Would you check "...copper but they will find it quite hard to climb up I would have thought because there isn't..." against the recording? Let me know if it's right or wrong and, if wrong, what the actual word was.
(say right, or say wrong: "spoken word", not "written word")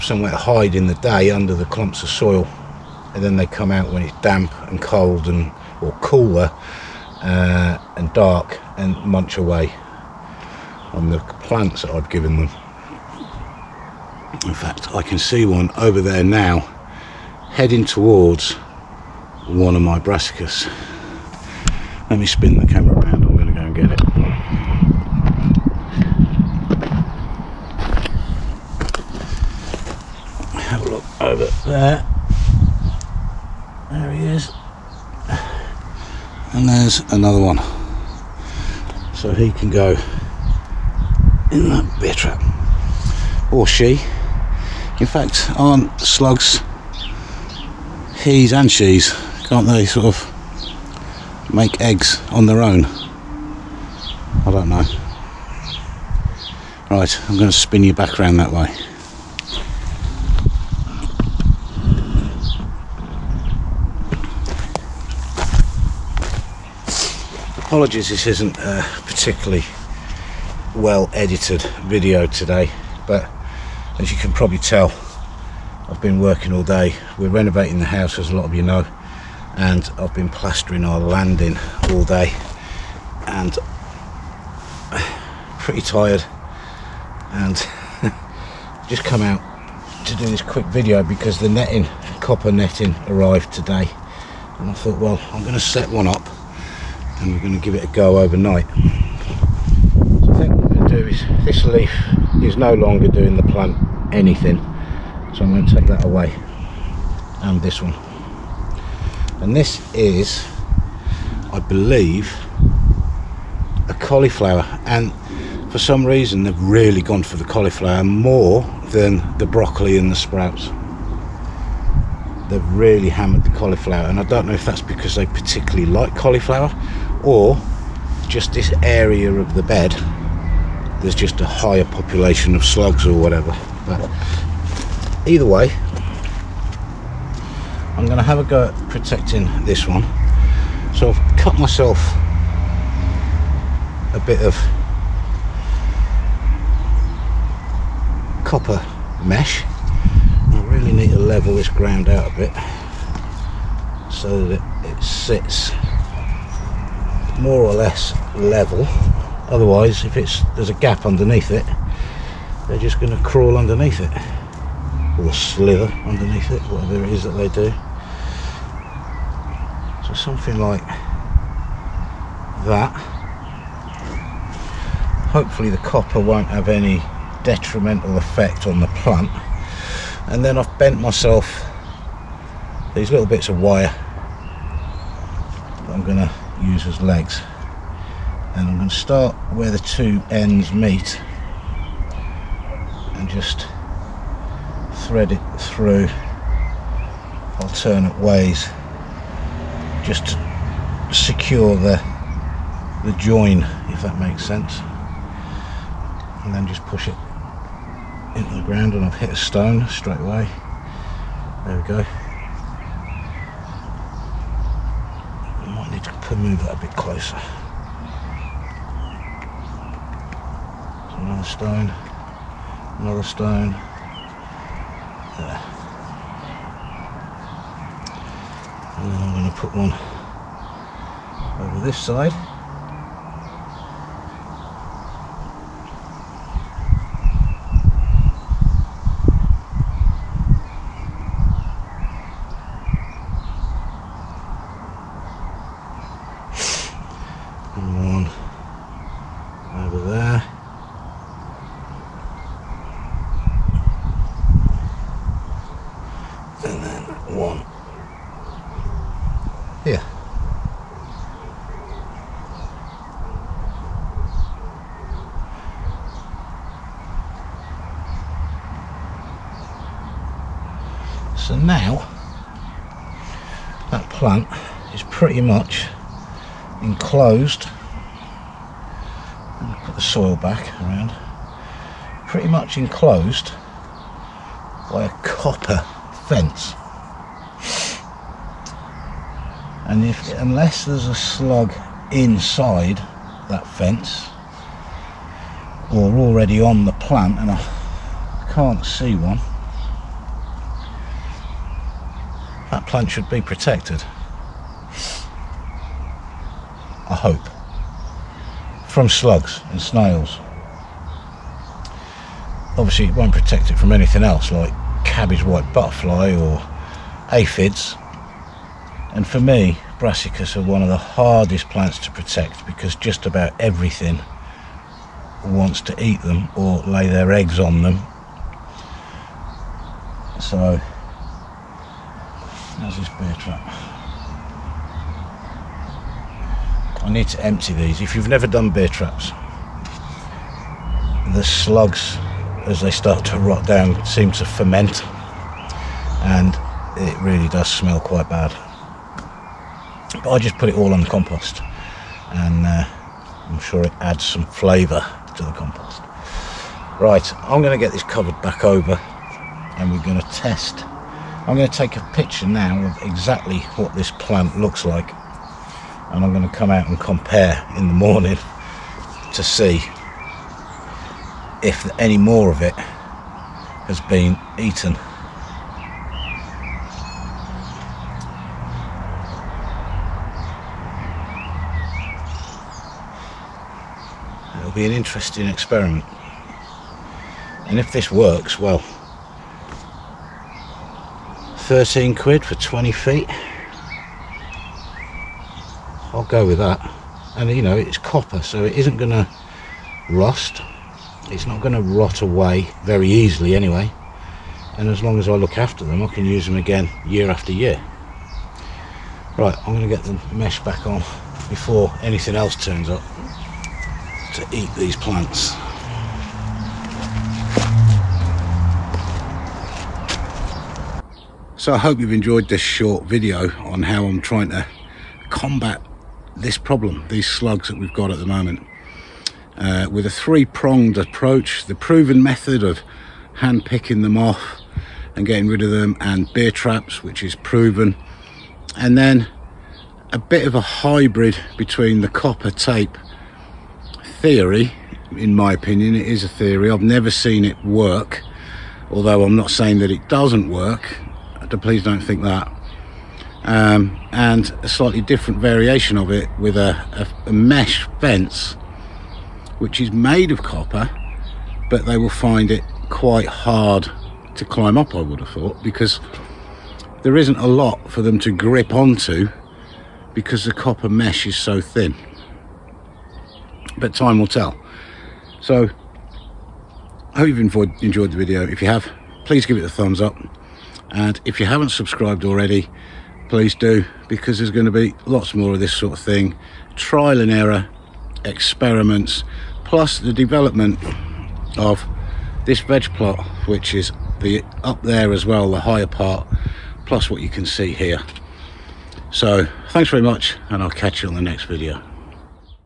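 right.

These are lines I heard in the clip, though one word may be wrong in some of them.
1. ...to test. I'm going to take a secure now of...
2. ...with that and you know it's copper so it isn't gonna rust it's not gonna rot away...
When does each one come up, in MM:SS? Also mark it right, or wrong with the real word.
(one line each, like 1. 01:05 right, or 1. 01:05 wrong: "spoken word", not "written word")
1. 06:00 wrong: "picture", not "secure"
2. 06:36 right.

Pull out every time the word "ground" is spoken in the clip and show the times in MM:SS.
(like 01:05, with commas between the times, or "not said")
02:31, 03:28.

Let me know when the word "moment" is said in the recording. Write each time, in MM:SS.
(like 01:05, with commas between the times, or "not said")
07:08.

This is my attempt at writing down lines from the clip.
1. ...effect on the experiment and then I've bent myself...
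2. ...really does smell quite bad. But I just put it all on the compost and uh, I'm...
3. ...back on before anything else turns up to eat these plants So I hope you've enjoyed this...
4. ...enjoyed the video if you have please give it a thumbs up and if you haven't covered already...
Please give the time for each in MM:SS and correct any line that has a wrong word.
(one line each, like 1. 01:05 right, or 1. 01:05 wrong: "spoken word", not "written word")
1. 02:58 wrong: "plant", not "experiment"
2. 05:47 right
3. 06:50 right
4. 07:57 wrong: "subscribed", not "covered".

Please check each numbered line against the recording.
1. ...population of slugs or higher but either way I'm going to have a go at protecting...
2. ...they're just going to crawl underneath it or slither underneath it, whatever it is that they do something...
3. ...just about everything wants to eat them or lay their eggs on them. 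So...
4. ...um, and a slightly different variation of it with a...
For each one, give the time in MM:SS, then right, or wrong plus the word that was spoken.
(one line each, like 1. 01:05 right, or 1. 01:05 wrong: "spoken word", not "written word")
1. 02:11 wrong: "whatever", not "higher"
2. 02:42 right
3. 05:22 right
4. 07:33 right.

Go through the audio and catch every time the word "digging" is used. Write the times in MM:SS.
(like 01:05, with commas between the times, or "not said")
not said.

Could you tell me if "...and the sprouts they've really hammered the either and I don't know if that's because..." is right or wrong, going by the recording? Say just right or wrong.
wrong.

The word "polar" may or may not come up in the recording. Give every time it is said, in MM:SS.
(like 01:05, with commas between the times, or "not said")
not said.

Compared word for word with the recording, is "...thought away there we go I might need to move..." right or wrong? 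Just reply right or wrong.
wrong.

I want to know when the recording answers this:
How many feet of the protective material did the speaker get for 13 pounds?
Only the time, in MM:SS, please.
06:32.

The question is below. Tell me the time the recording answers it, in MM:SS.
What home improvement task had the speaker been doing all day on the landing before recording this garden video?
01:20.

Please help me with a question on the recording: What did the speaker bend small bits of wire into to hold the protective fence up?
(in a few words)
Legs.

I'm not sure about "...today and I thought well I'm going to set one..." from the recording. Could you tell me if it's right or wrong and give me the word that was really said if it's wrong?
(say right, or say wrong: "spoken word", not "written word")
right.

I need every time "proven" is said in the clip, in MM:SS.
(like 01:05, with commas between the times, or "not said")
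07:11, 07:17.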